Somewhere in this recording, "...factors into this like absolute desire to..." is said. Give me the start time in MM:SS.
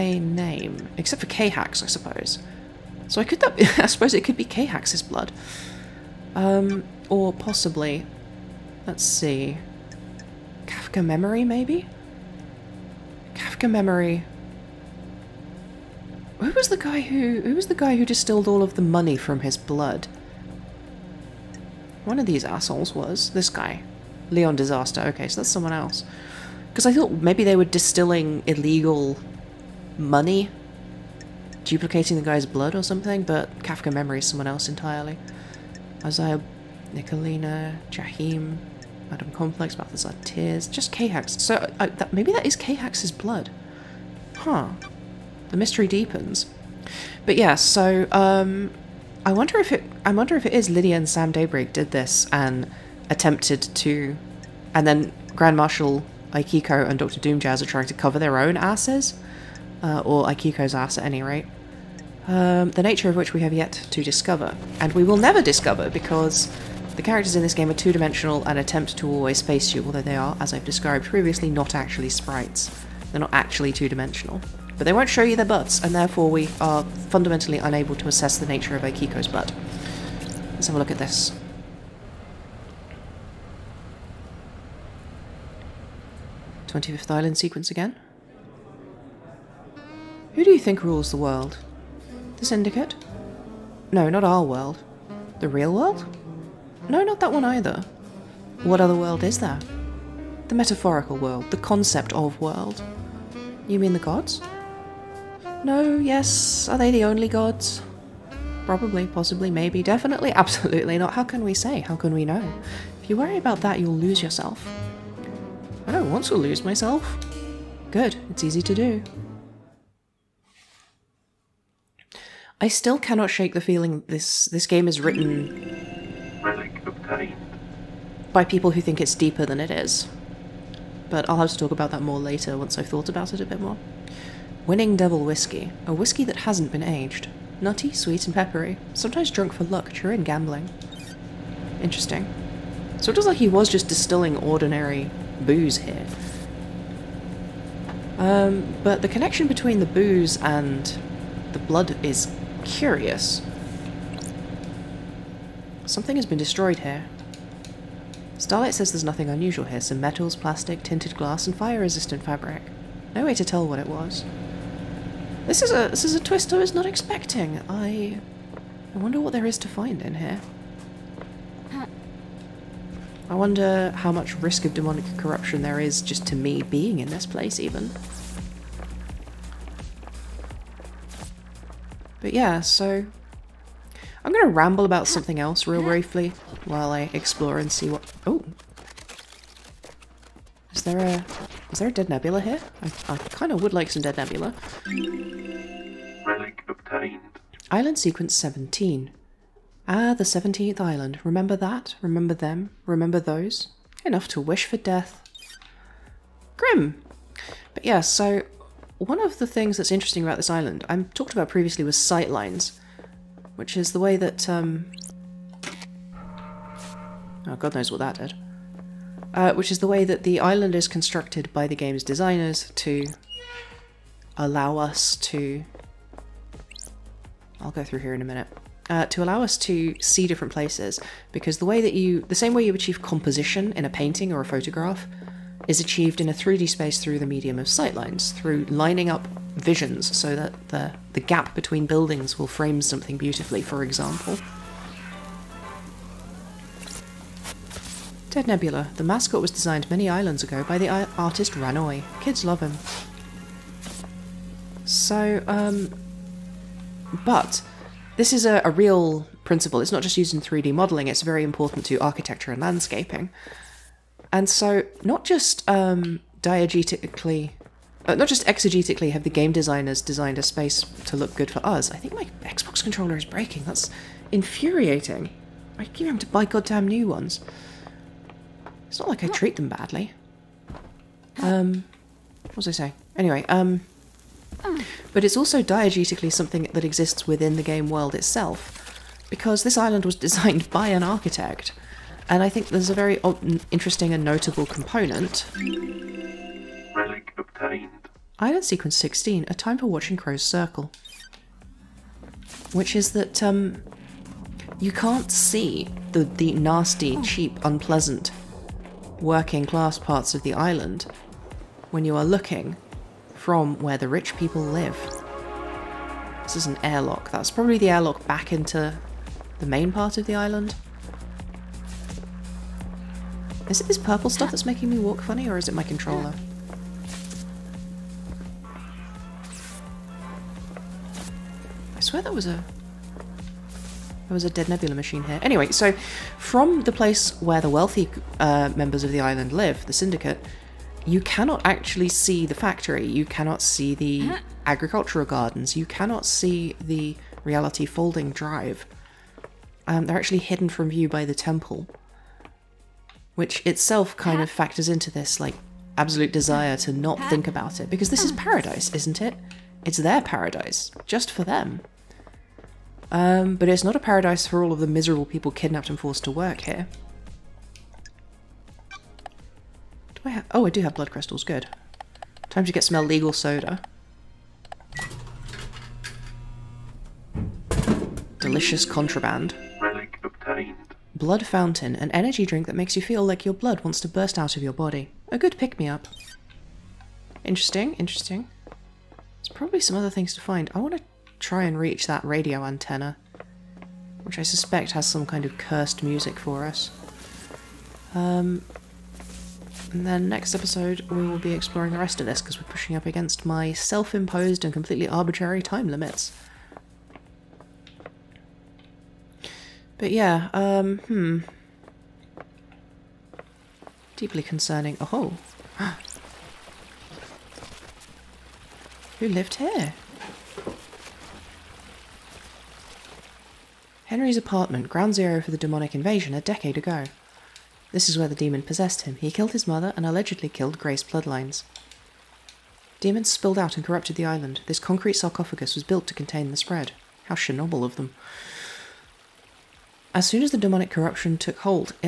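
05:54.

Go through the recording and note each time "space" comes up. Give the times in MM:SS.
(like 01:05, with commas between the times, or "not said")
03:56, 04:30.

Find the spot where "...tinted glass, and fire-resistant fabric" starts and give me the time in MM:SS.
02:40.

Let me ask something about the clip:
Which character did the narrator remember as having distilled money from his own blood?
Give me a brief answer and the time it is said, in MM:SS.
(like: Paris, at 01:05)
Leon Disaster, at 00:24.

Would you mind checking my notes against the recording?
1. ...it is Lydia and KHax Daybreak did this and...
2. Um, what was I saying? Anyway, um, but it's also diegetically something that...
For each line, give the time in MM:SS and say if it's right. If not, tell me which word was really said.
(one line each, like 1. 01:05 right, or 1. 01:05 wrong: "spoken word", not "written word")
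1. 00:50 wrong: "Sam", not "KHax"
2. 04:41 right.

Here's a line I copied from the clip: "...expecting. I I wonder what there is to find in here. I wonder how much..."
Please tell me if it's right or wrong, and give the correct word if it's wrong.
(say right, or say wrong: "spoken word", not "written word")
right.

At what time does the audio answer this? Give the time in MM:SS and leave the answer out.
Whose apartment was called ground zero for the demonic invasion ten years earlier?
07:04.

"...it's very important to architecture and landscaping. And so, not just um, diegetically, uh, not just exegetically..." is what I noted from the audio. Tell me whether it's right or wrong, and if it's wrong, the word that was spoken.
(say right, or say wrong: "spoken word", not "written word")
right.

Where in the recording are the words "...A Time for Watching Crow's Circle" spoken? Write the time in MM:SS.
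04:59.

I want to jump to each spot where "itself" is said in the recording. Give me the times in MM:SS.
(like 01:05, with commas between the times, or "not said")
04:48, 05:53.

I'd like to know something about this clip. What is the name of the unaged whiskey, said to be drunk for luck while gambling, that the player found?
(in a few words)
Winning Devil Whiskey.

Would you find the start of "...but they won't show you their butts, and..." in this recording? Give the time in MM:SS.
01:14.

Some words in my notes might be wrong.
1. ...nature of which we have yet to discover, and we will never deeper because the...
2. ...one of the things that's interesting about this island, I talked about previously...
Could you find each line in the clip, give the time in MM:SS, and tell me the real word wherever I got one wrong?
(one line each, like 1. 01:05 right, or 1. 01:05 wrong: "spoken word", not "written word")
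1. 01:02 wrong: "discover", not "deeper"
2. 03:28 right.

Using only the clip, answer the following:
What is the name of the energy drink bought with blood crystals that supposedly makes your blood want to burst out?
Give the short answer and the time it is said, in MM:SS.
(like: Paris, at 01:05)
Blood Fountain, at 06:21.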